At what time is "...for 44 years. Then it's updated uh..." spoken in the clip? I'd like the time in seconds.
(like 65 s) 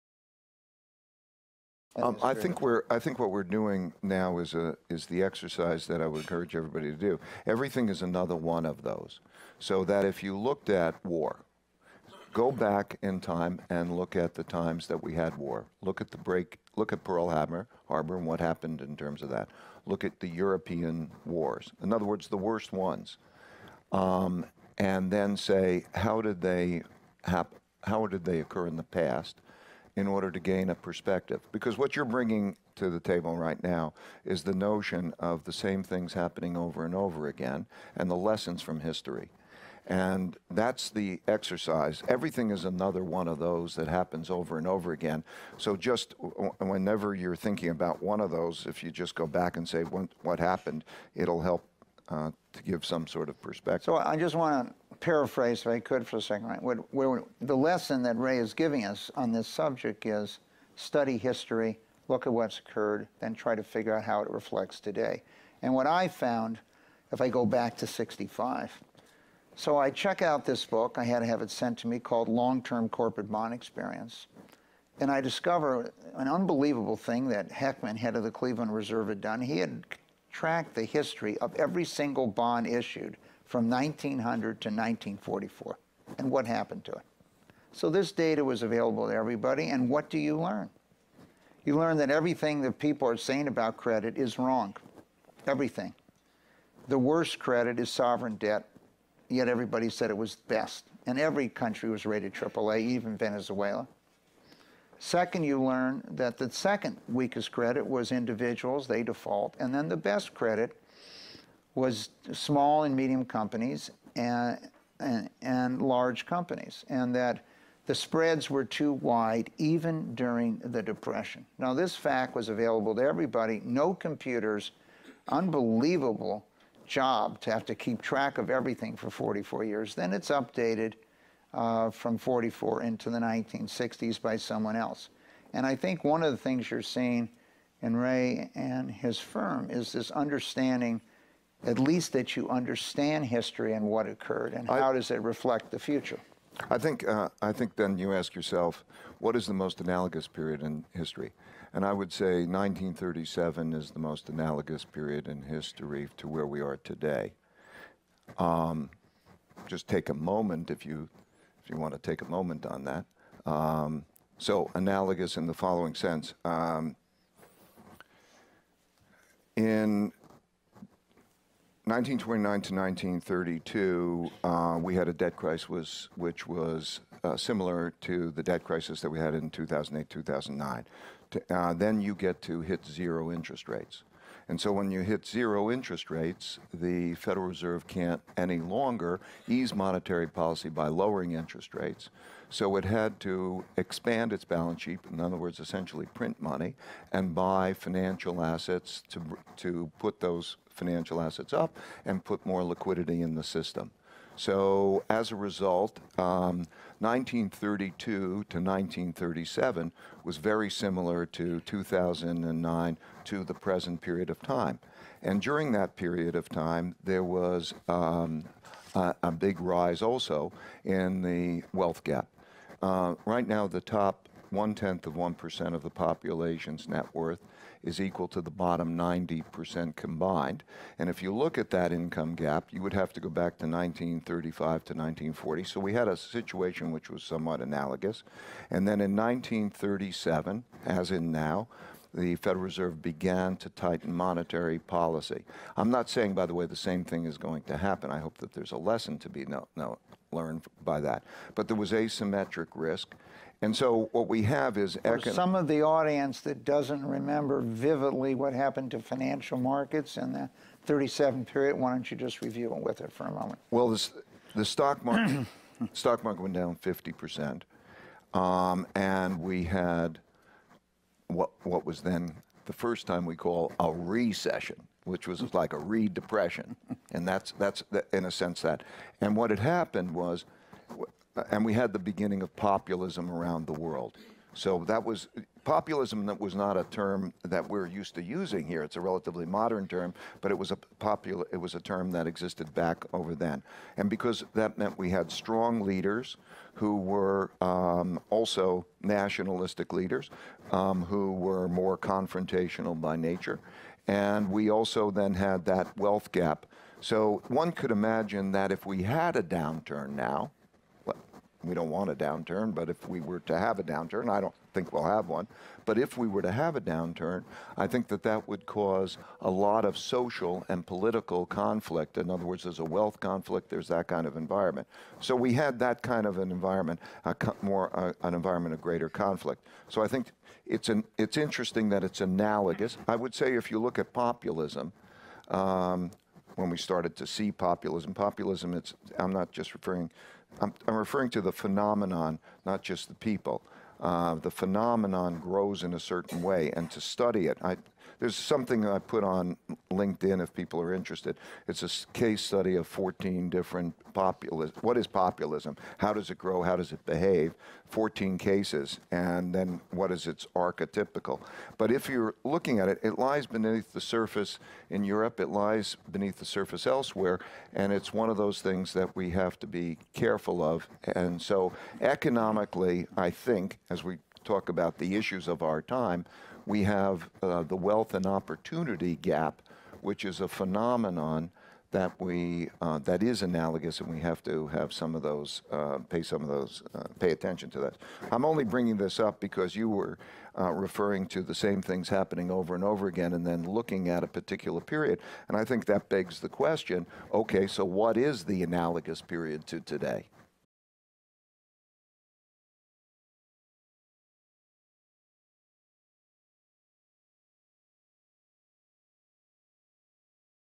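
128 s.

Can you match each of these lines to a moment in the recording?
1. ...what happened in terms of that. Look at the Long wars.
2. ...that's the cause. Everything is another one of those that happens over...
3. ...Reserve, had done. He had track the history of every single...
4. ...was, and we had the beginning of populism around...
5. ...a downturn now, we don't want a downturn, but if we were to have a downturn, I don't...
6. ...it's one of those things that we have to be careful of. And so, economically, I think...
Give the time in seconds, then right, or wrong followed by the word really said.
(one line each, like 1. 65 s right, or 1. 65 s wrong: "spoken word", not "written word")
1. 18 s wrong: "European", not "Long"
2. 40 s wrong: "exercise", not "cause"
3. 78 s right
4. 280 s right
5. 309 s right
6. 367 s right.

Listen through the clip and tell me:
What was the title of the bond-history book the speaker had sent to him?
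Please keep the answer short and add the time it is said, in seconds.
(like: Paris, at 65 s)
Long Term Corporate Bond Experience, at 72 s.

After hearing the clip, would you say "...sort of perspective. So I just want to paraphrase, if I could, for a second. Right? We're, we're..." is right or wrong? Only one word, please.
right.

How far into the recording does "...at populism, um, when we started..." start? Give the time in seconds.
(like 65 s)
333 s.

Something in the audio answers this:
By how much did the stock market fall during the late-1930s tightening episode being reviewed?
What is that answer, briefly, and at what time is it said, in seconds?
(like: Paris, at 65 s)
50 percent, at 266 s.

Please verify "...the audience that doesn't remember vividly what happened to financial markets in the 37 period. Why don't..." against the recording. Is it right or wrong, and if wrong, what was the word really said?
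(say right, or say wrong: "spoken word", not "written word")
right.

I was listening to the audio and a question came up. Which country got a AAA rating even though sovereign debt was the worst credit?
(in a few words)
Venezuela.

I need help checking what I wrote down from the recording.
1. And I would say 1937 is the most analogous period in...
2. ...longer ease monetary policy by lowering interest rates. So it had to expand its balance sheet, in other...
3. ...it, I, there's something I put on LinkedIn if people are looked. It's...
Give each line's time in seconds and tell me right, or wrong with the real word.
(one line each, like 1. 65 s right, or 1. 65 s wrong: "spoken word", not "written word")
1. 151 s right
2. 188 s right
3. 347 s wrong: "interested", not "looked".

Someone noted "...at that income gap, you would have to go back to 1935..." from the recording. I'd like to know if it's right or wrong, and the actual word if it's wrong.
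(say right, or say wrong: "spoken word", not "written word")
right.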